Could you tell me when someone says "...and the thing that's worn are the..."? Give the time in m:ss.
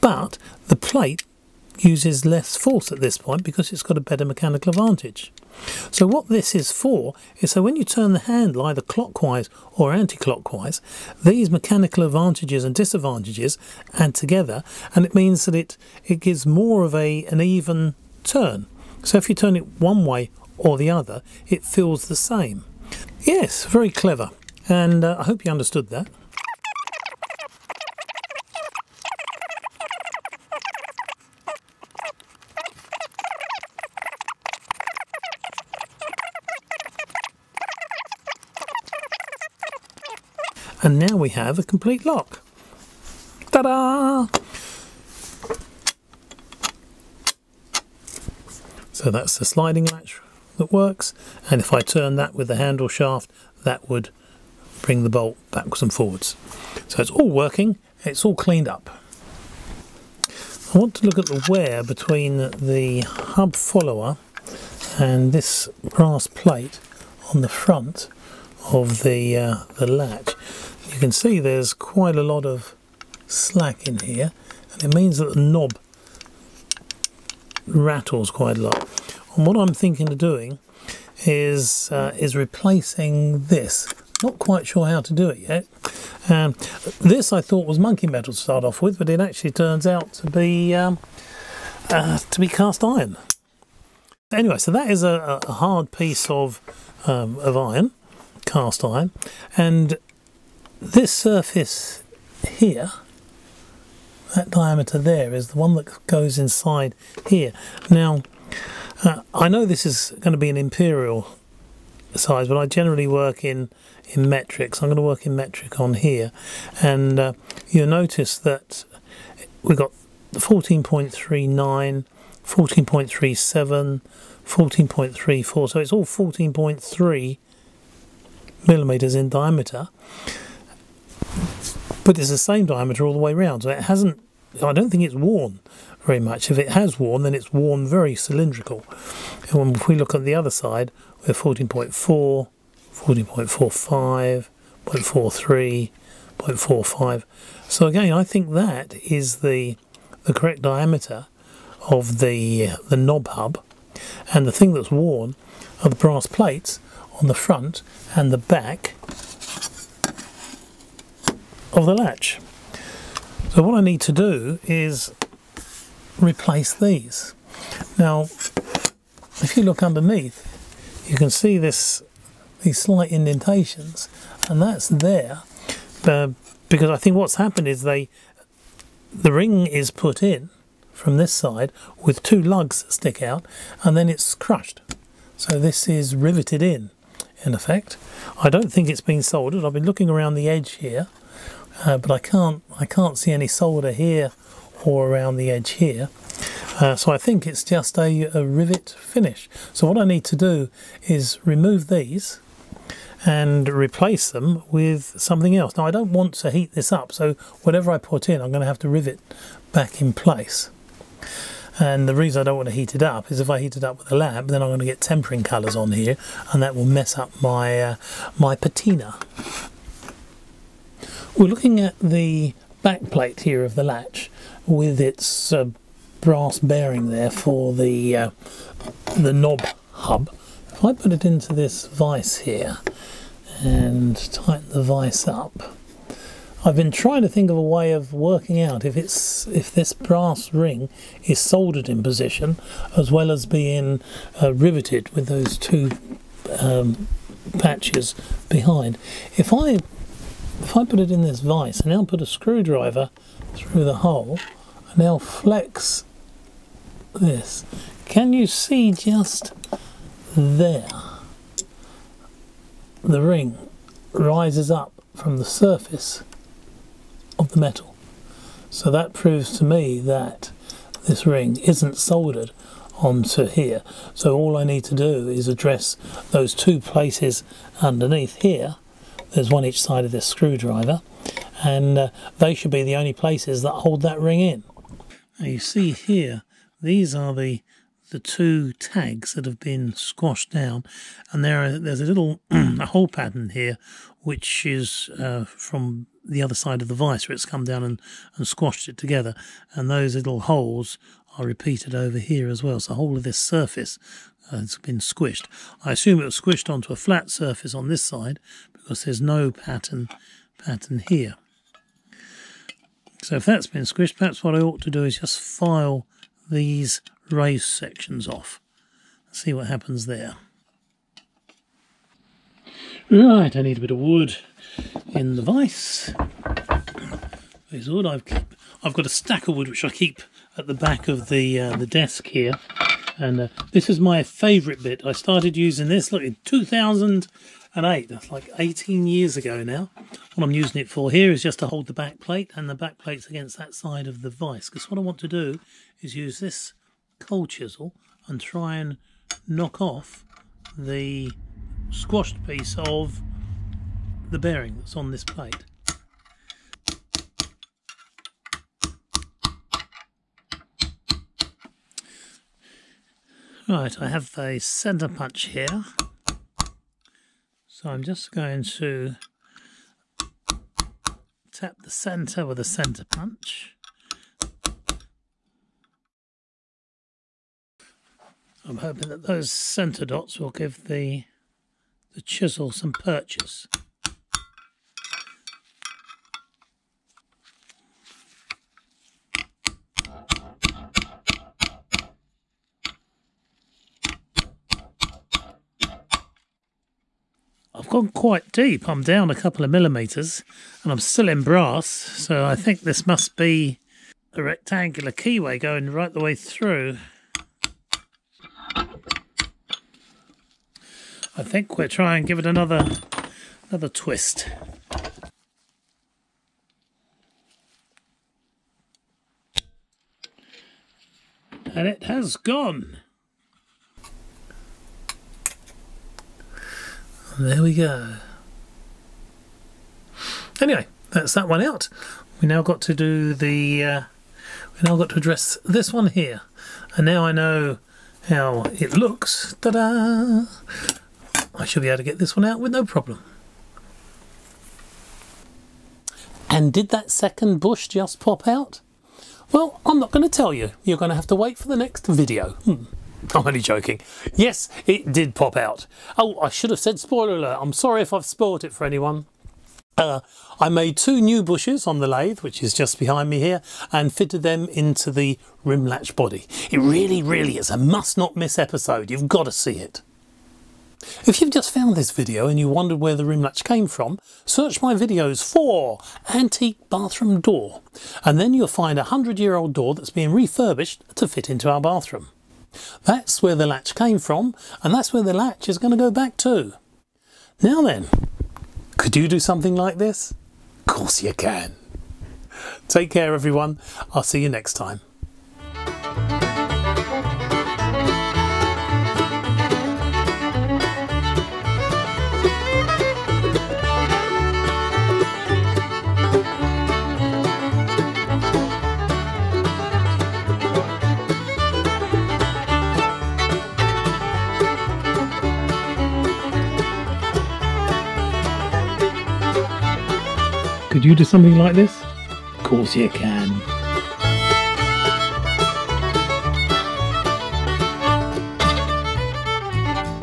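2:34.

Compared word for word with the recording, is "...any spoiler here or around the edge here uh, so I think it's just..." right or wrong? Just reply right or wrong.
wrong.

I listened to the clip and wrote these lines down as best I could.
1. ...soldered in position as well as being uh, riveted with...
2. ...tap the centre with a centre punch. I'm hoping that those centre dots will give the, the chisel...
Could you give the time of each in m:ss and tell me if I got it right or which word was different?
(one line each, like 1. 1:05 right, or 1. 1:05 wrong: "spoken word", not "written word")
1. 4:01 right
2. 6:11 right.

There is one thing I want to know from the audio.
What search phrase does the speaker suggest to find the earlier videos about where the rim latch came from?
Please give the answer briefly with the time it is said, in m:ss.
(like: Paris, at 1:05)
antique bathroom door, at 7:56.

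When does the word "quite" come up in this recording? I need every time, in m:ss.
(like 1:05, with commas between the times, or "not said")
1:11, 1:18, 1:24, 6:38.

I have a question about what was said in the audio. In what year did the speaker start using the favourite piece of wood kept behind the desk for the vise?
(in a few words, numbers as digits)
2008.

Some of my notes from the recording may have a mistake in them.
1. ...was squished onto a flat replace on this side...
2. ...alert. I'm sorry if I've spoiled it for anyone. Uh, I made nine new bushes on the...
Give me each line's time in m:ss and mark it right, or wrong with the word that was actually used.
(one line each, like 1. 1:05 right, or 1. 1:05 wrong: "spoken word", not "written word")
1. 5:06 wrong: "surface", not "replace"
2. 7:37 wrong: "two", not "nine".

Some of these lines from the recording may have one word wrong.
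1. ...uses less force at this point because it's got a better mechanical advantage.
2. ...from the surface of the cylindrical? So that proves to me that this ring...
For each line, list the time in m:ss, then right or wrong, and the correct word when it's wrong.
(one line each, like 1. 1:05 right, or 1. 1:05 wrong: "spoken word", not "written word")
1. 0:01 right
2. 4:25 wrong: "metal", not "cylindrical".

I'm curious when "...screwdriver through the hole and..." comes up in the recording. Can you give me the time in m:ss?
4:12.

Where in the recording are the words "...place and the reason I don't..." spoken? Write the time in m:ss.
3:30.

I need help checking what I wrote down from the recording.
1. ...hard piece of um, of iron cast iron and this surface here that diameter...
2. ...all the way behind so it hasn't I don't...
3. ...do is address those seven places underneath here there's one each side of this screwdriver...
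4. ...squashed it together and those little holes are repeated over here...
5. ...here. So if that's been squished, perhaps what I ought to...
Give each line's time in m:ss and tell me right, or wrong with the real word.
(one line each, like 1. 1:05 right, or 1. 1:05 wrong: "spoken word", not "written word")
1. 1:35 right
2. 2:13 wrong: "round", not "behind"
3. 4:34 wrong: "two", not "seven"
4. 4:58 right
5. 5:11 right.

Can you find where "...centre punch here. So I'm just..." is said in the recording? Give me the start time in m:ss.
6:04.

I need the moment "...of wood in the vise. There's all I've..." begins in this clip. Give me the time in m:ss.
5:23.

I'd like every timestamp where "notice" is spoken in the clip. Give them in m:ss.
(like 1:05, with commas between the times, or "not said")
1:57.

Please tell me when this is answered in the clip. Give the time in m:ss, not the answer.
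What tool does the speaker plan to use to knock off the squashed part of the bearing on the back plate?
5:47.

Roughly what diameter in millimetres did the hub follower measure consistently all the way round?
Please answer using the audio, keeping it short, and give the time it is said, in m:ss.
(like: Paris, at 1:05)
14.3 millimetres, at 2:06.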